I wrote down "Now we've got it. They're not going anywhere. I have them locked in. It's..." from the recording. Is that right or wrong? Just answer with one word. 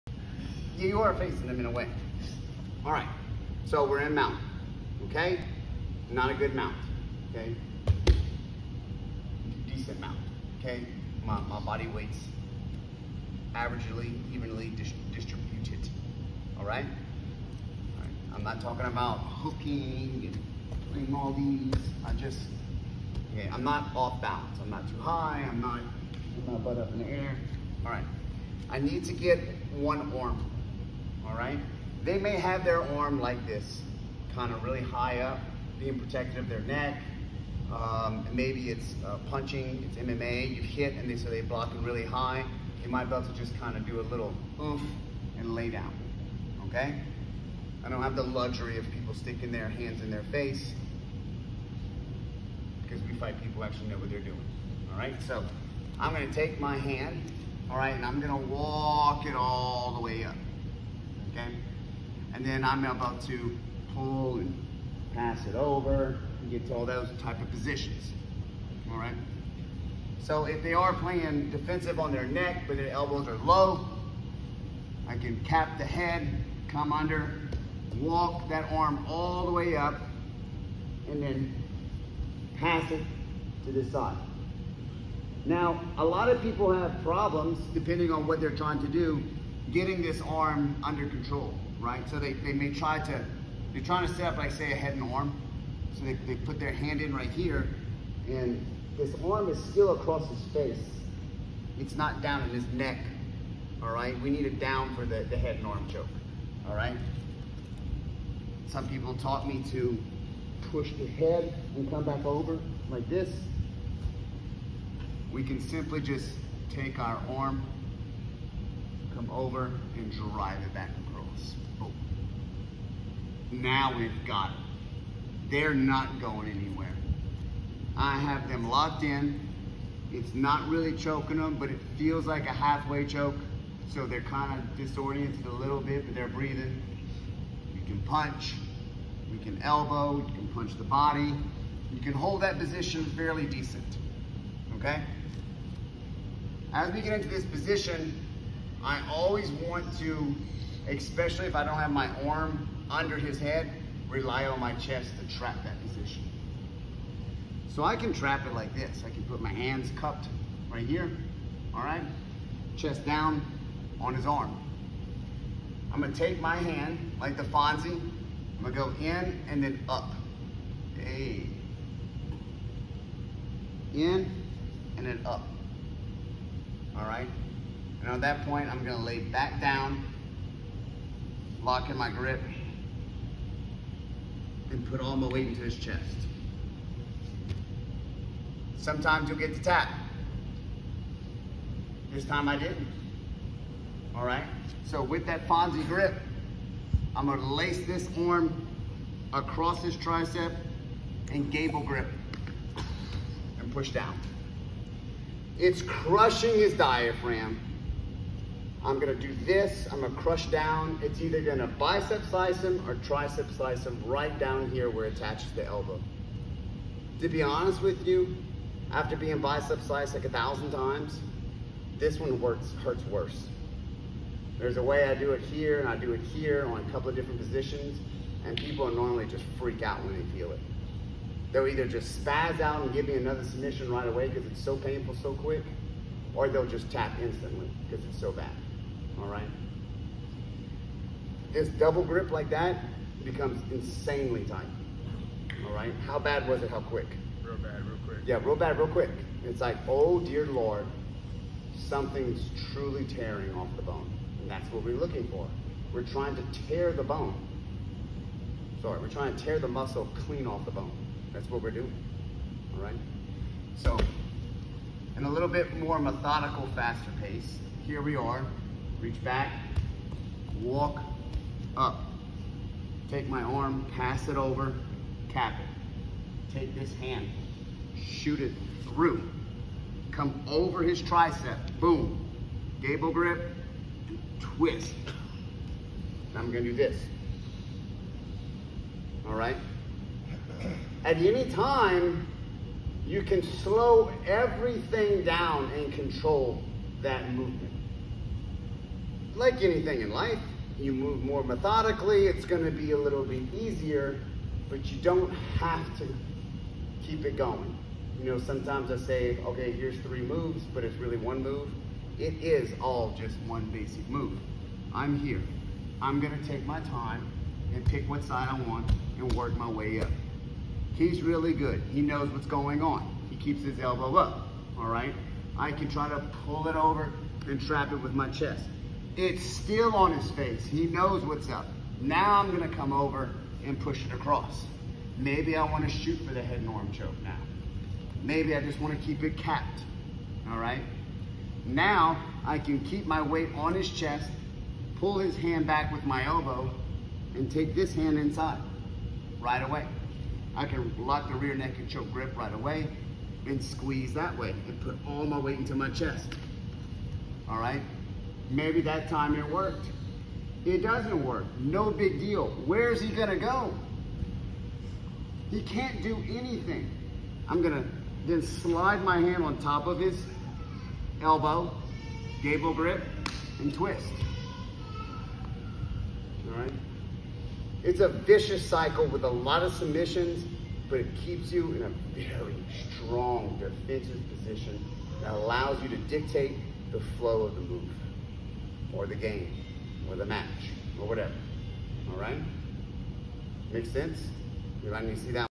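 right.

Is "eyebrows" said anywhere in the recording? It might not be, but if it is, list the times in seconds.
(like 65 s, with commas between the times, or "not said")
not said.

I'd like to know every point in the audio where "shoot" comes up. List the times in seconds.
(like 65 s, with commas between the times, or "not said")
277 s, 335 s.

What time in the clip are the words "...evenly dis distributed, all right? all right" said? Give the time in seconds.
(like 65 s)
14 s.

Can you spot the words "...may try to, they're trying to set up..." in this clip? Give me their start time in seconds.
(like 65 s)
92 s.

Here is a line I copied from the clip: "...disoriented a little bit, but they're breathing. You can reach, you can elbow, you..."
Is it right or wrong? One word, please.
wrong.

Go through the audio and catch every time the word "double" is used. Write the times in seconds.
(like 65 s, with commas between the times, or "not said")
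241 s.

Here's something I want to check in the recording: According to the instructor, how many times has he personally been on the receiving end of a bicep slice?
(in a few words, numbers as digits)
1000.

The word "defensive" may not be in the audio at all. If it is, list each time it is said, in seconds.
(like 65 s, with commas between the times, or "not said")
71 s, 383 s.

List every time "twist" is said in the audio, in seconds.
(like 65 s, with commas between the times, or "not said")
284 s, 373 s.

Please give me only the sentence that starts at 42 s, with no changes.
You might be able to just kind of do a little oof and lay down, okay?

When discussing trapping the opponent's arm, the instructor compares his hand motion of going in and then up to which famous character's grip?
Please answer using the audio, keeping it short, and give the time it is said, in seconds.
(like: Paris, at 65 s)
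The Fonzie, at 167 s.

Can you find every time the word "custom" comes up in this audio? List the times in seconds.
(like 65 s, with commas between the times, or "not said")
not said.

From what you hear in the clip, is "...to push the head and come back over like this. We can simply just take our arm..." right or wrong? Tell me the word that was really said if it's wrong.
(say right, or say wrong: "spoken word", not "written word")
right.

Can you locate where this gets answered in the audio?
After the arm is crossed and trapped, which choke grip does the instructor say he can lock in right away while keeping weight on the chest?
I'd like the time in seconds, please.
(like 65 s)
351 s.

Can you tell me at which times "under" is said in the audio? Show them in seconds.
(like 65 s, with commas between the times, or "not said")
76 s, 90 s, 152 s.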